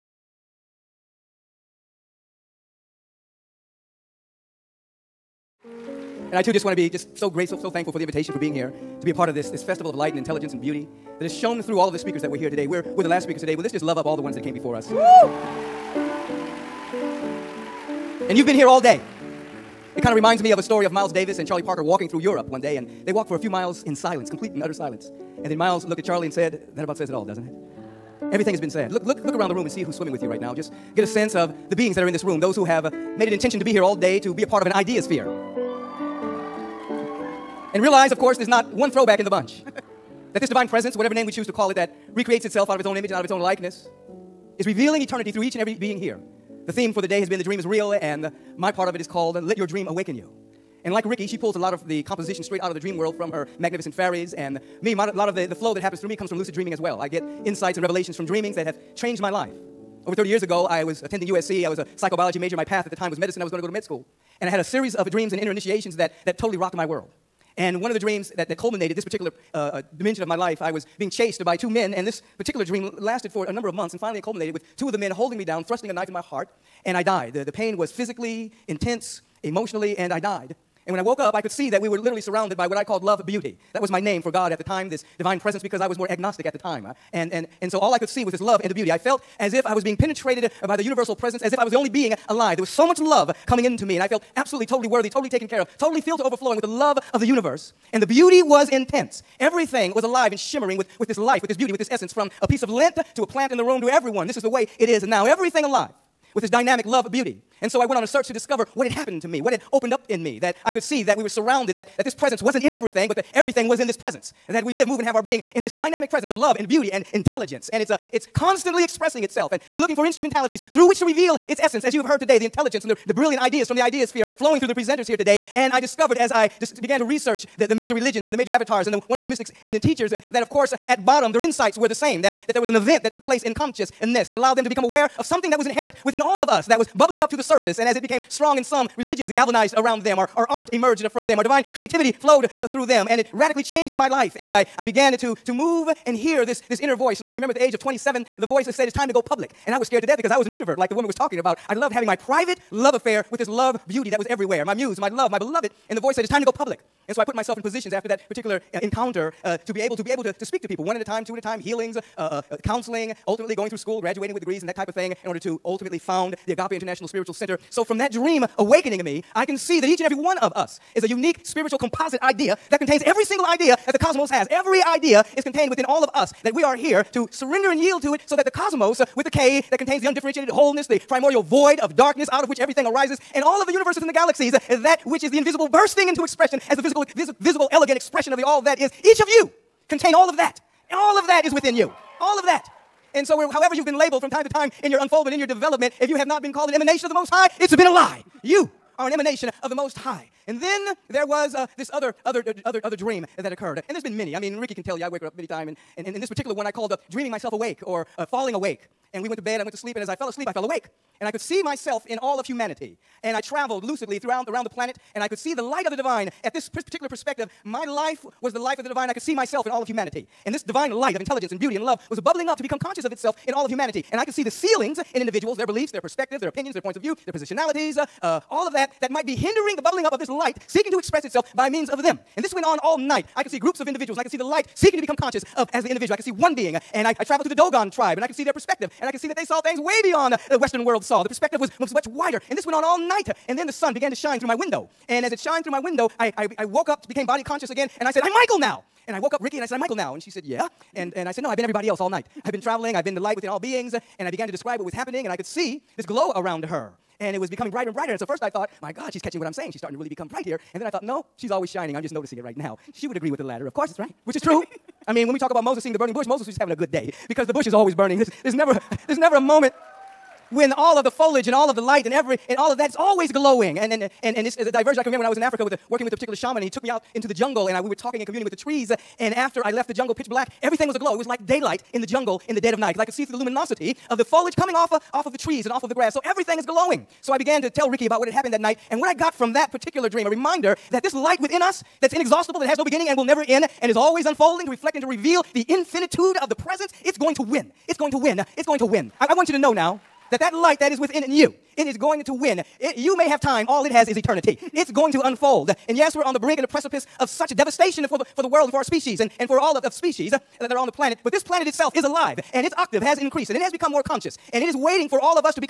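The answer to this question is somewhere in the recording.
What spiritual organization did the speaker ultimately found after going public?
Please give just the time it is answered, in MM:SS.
02:46.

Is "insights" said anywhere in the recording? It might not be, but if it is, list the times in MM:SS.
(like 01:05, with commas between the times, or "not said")
00:57, 02:11.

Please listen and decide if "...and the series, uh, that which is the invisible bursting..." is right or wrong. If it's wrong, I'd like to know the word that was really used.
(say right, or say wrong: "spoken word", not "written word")
wrong: "galaxies", not "series".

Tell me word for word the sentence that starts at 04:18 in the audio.
And so first I thought, my God, she's catching what I'm saying.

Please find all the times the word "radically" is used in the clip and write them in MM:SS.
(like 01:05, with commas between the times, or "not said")
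02:23.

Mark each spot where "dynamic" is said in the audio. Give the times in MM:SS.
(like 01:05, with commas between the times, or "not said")
01:46, 01:55.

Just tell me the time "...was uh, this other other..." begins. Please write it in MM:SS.
03:21.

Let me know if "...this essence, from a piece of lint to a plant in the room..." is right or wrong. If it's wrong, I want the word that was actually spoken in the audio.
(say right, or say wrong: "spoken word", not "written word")
right.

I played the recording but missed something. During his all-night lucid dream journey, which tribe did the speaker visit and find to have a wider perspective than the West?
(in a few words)
Dogon.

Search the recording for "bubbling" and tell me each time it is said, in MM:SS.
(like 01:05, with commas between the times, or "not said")
02:16, 03:42, 03:49.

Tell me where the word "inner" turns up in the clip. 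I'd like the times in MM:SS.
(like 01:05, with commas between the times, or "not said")
01:05, 02:26.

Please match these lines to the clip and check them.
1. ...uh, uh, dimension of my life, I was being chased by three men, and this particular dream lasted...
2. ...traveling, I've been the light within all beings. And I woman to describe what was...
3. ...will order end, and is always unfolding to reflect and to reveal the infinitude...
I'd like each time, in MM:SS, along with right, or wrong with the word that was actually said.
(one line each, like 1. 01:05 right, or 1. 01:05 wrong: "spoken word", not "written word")
1. 01:09 wrong: "two", not "three"
2. 04:12 wrong: "began", not "woman"
3. 04:53 wrong: "never", not "order".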